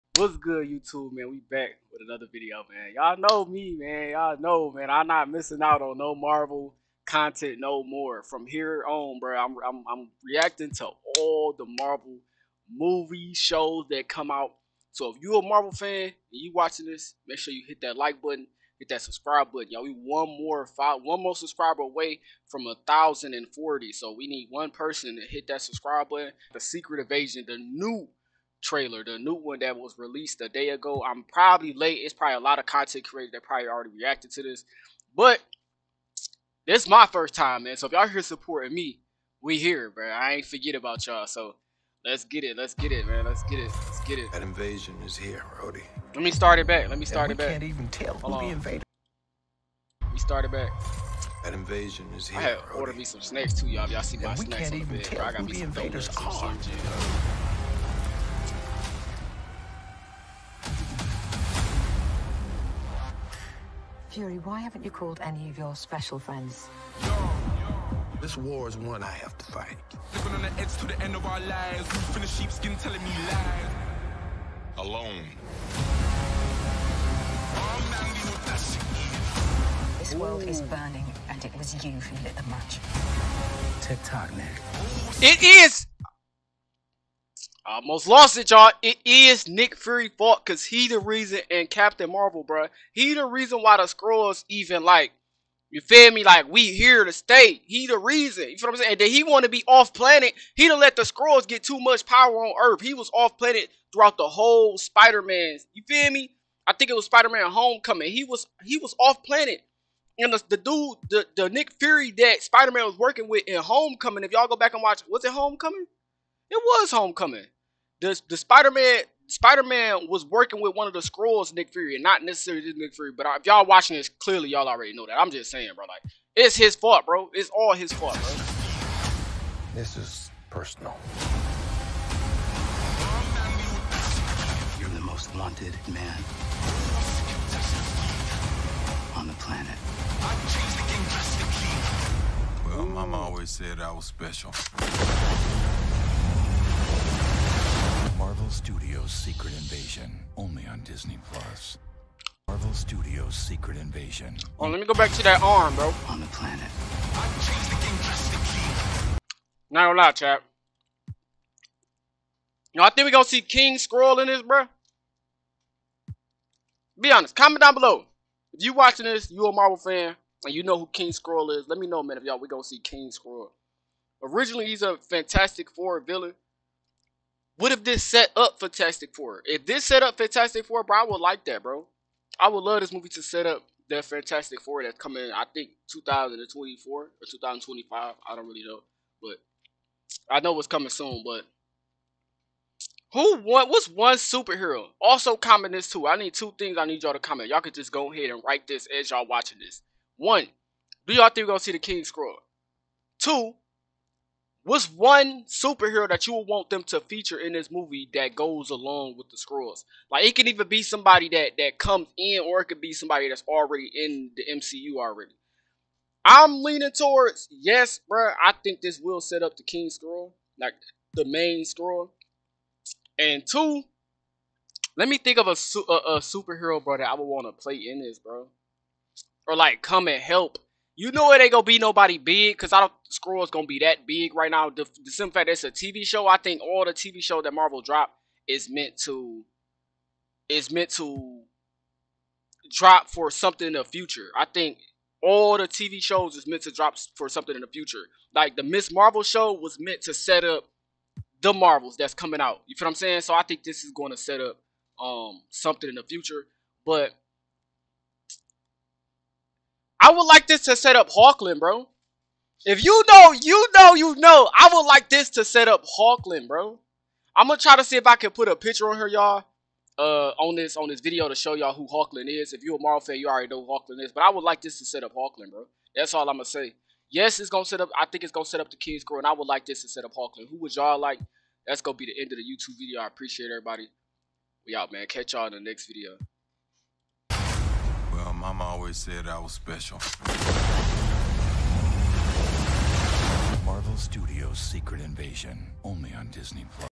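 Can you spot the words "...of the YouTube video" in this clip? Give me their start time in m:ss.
4:42.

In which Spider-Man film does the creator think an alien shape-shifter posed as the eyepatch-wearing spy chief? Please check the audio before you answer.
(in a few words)
Spider-Man Homecoming.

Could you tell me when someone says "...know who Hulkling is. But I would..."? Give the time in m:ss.
4:33.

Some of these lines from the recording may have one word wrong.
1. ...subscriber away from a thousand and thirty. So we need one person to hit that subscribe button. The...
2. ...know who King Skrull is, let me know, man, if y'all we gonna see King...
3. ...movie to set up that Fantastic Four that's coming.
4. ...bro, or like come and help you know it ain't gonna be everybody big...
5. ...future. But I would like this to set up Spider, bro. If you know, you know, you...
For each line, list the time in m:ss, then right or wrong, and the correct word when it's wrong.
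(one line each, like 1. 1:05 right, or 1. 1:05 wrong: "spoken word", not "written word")
1. 0:21 wrong: "forty", not "thirty"
2. 2:50 right
3. 3:02 right
4. 3:48 wrong: "nobody", not "everybody"
5. 4:16 wrong: "Hulkling", not "Spider".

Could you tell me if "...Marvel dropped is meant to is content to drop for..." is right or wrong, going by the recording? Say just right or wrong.
wrong.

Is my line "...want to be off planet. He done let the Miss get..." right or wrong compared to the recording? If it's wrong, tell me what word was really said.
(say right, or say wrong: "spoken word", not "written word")
wrong: "Skrulls", not "Miss".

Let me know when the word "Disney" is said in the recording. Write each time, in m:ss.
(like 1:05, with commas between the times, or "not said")
2:30, 4:56.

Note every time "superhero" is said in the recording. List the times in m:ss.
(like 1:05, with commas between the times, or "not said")
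3:14, 3:25, 3:46.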